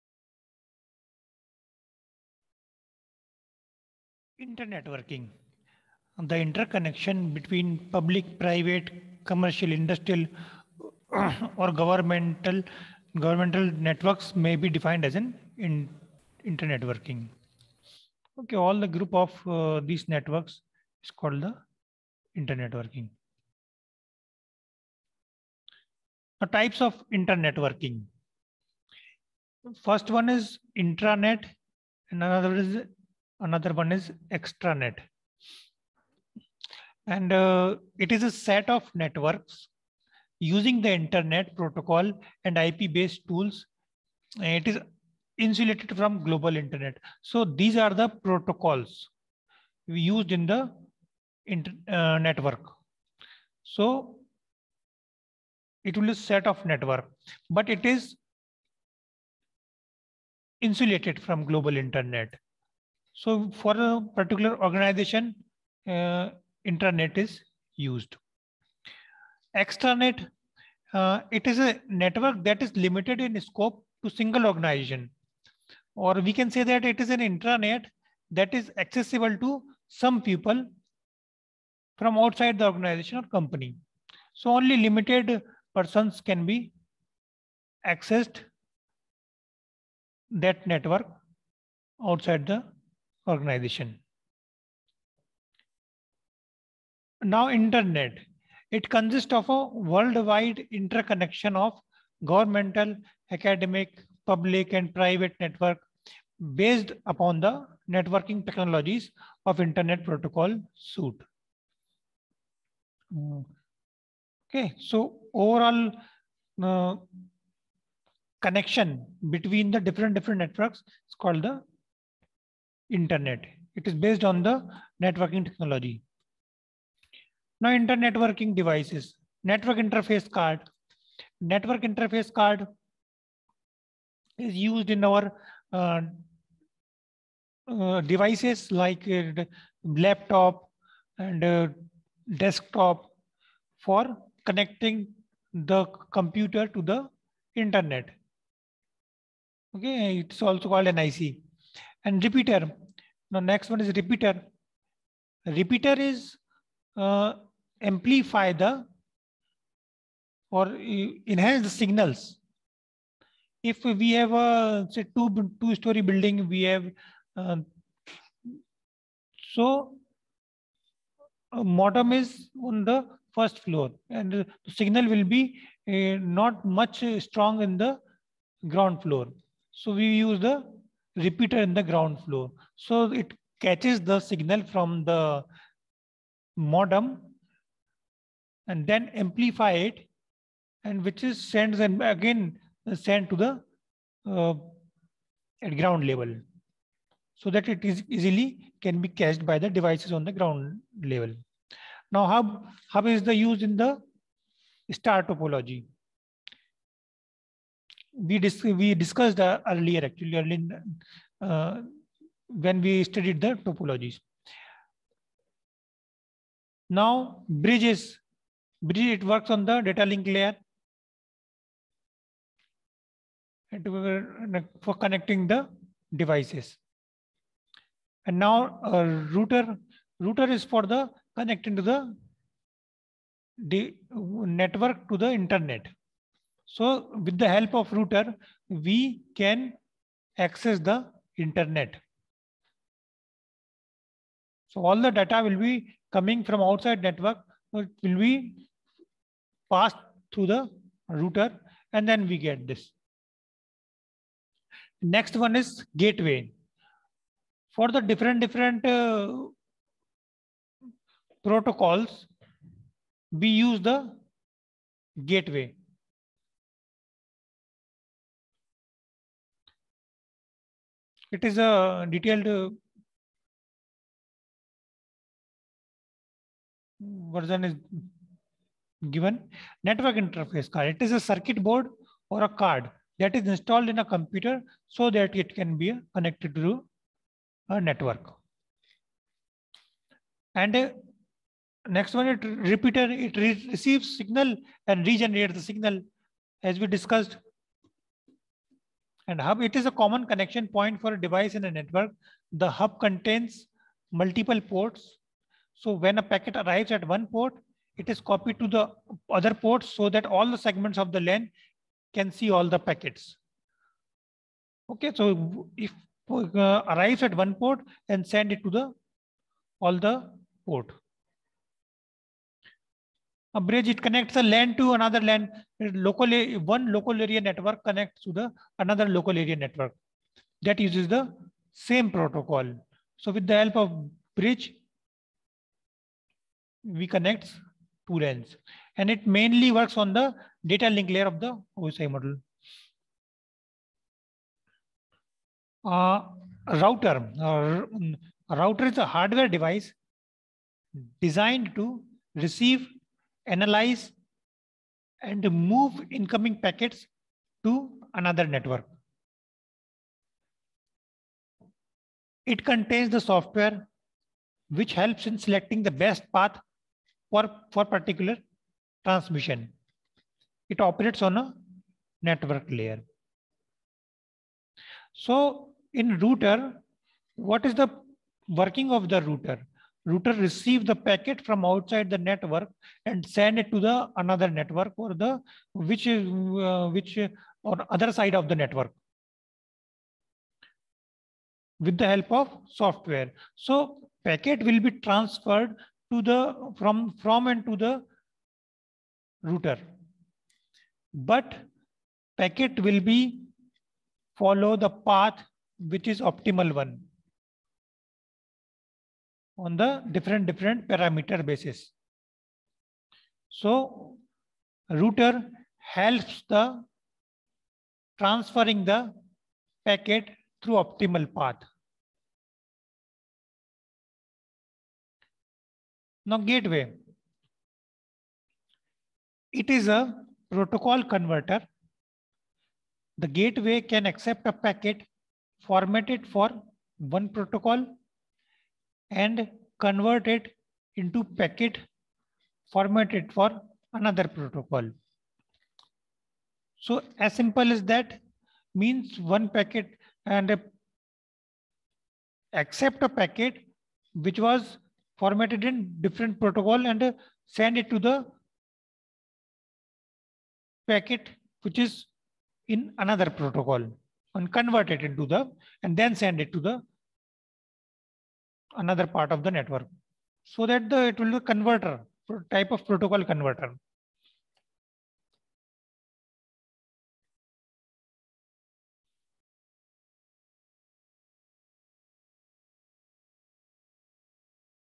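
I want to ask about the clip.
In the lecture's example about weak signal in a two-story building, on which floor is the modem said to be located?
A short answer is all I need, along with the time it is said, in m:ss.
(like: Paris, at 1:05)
First floor, at 2:53.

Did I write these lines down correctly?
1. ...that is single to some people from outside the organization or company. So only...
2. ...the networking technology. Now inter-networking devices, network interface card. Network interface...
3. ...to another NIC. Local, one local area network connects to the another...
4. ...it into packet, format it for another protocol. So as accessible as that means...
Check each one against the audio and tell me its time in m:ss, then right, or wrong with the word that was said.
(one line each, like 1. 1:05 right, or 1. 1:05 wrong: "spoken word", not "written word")
1. 1:18 wrong: "accessible", not "single"
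2. 2:04 right
3. 5:24 wrong: "LAN", not "NIC"
4. 7:20 wrong: "simple", not "accessible".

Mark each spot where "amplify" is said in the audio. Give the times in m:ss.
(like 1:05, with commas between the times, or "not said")
2:37, 3:09.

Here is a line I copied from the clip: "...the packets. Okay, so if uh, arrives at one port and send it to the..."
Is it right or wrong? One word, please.
right.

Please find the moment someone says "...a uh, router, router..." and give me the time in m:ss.
3:48.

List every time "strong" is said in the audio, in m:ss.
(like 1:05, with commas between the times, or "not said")
2:57.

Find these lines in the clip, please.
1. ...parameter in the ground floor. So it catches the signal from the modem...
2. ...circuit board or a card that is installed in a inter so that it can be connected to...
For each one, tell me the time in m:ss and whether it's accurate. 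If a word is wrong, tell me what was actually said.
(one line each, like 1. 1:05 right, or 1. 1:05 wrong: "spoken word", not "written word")
1. 3:01 wrong: "repeater", not "parameter"
2. 4:41 wrong: "computer", not "inter".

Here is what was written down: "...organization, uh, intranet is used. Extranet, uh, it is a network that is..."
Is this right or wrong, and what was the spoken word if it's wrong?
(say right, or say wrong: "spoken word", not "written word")
right.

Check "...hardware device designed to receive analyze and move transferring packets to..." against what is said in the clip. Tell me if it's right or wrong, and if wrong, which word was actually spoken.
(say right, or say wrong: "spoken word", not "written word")
wrong: "incoming", not "transferring".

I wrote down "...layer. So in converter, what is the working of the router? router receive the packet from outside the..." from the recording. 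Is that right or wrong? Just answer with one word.
wrong.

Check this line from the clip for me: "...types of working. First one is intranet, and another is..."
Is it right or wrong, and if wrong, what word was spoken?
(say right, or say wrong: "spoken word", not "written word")
right.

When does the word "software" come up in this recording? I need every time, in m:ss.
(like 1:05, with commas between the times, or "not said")
6:03, 6:32.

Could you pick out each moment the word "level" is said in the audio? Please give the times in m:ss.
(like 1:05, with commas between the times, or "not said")
3:16, 3:21.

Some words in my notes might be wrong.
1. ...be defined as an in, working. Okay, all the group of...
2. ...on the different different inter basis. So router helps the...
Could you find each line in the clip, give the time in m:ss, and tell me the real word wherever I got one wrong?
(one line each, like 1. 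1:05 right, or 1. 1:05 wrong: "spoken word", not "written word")
1. 0:14 right
2. 6:49 wrong: "parameter", not "inter".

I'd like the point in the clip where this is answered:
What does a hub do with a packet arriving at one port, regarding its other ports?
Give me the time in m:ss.
5:08.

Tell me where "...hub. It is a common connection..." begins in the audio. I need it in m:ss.
4:59.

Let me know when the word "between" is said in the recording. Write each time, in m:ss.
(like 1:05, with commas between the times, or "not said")
0:07, 1:59.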